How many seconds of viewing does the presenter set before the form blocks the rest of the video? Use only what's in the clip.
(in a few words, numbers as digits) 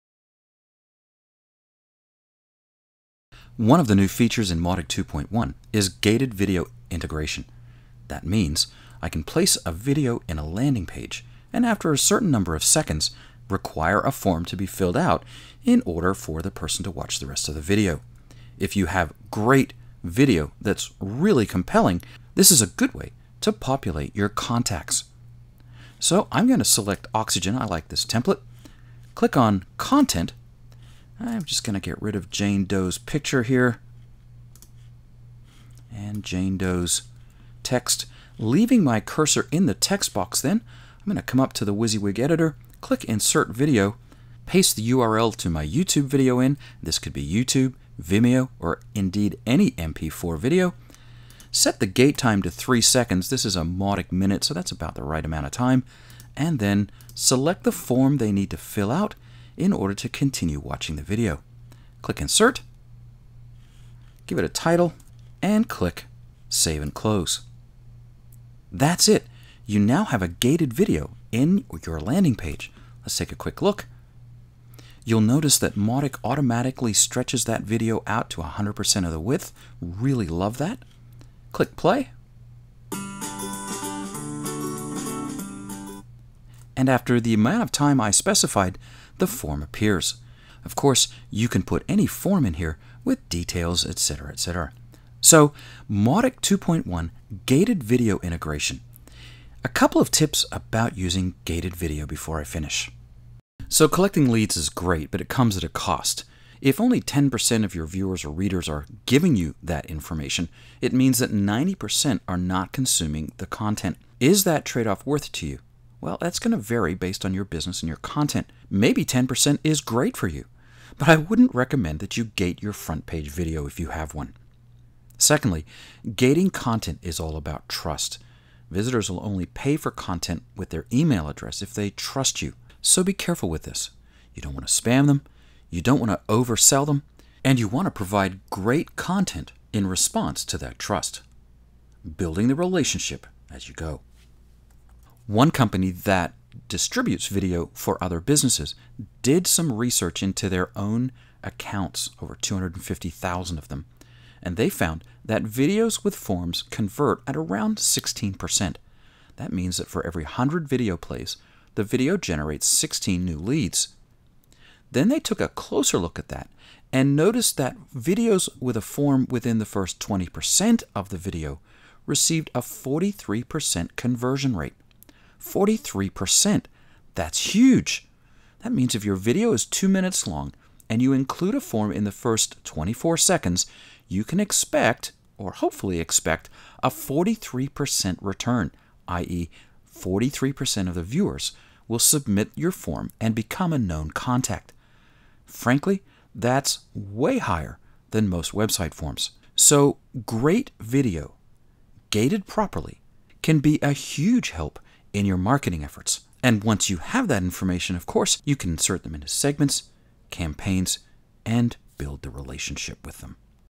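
3 seconds.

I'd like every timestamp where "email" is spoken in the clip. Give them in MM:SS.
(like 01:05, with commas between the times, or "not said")
02:10.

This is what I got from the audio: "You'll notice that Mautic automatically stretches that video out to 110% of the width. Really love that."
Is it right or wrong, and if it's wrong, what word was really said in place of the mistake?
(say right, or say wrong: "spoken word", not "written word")
wrong: "100", not "110".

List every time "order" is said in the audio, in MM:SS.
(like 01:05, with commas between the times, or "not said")
00:15, 00:59.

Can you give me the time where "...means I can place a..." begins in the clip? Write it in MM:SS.
00:08.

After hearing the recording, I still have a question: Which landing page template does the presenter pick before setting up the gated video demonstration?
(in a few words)
Oxygen.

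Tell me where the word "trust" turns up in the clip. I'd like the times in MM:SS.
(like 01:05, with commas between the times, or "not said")
02:07, 02:11, 02:20.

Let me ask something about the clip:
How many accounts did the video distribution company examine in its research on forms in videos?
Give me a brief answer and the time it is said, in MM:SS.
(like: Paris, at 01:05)
250,000, at 02:32.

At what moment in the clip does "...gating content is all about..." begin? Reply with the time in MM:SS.
02:06.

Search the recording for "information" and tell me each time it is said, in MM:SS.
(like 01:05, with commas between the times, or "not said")
01:49, 03:27.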